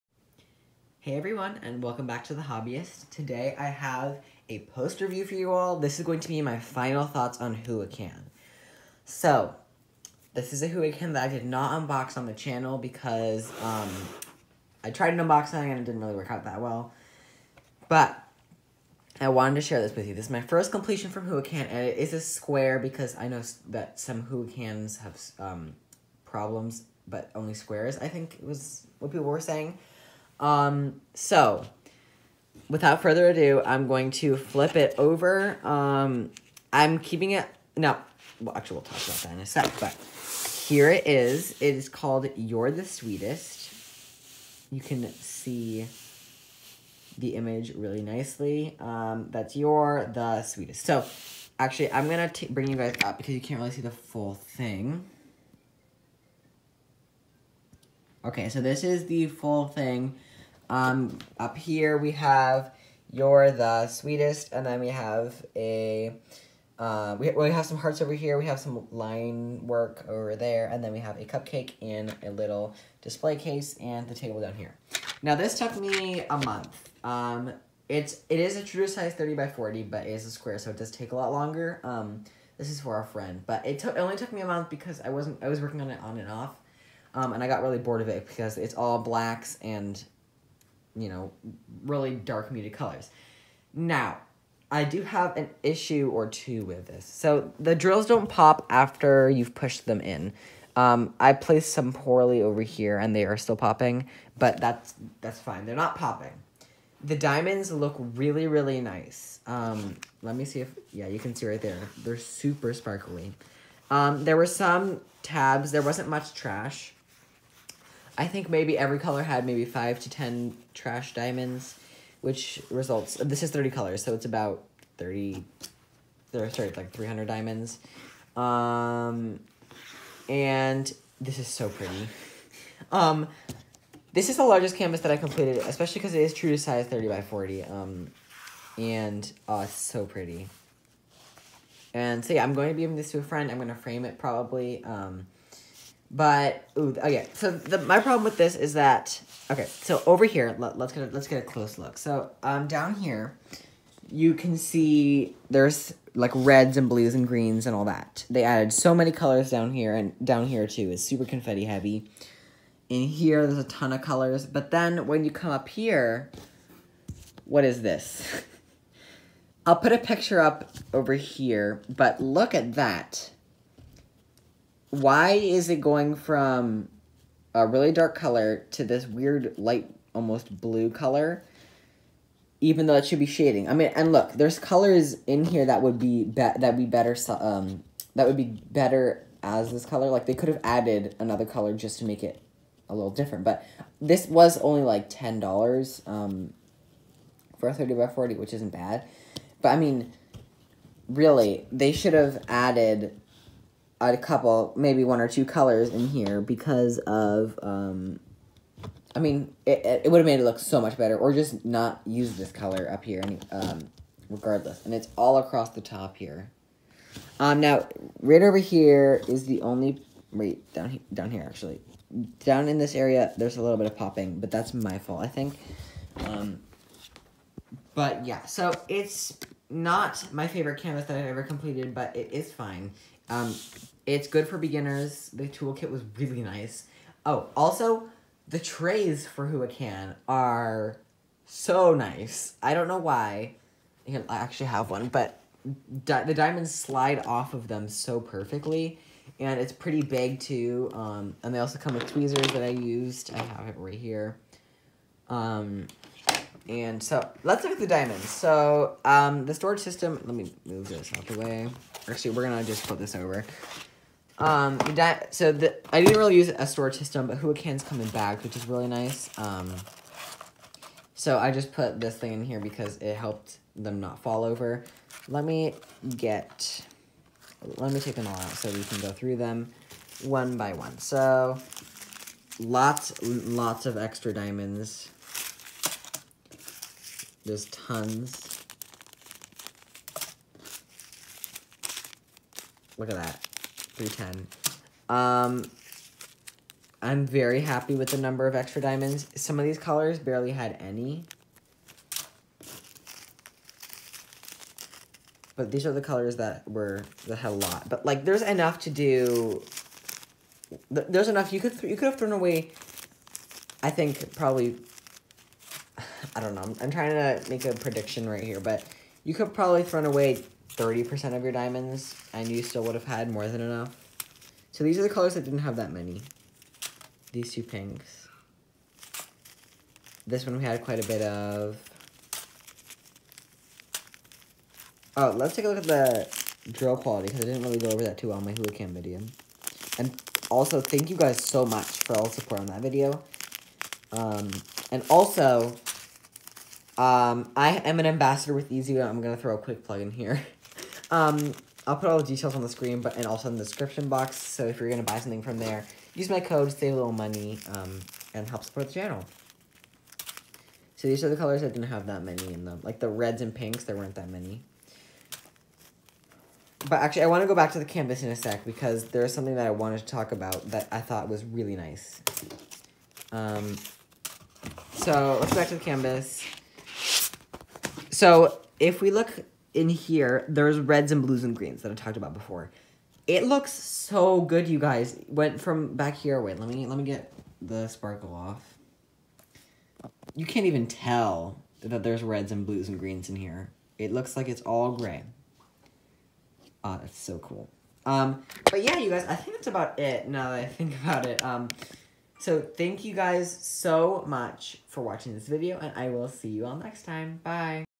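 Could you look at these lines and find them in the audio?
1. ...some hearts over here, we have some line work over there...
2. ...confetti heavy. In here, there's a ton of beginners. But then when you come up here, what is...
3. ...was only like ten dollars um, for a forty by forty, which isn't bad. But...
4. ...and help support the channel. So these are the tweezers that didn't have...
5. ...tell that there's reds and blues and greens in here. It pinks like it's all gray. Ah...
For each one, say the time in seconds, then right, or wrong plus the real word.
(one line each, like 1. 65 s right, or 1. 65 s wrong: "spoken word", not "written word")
1. 67 s right
2. 161 s wrong: "colors", not "beginners"
3. 194 s wrong: "thirty", not "forty"
4. 358 s wrong: "colors", not "tweezers"
5. 390 s wrong: "looks", not "pinks".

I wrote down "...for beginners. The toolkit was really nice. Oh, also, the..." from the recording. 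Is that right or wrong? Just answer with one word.
right.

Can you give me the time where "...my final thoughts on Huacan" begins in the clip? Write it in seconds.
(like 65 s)
6 s.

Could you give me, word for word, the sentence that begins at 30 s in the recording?
Um, so, without further ado, I'm going to flip it over.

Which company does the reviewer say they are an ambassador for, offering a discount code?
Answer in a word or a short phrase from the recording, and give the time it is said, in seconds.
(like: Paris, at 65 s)
Easy, at 348 s.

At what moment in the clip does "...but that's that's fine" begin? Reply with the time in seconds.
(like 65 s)
104 s.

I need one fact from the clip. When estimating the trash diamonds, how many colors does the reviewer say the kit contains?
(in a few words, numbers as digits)
30.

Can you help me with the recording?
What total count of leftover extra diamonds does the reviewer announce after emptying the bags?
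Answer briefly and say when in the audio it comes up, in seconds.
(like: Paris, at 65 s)
310, at 294 s.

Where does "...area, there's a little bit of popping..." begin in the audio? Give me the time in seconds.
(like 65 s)
222 s.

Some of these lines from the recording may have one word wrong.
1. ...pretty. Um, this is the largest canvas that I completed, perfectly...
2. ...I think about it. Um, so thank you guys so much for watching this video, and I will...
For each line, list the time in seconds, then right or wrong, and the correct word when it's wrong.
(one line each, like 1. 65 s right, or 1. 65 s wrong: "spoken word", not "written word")
1. 131 s wrong: "especially", not "perfectly"
2. 400 s right.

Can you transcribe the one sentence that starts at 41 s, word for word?
It is called You're the Sweetest.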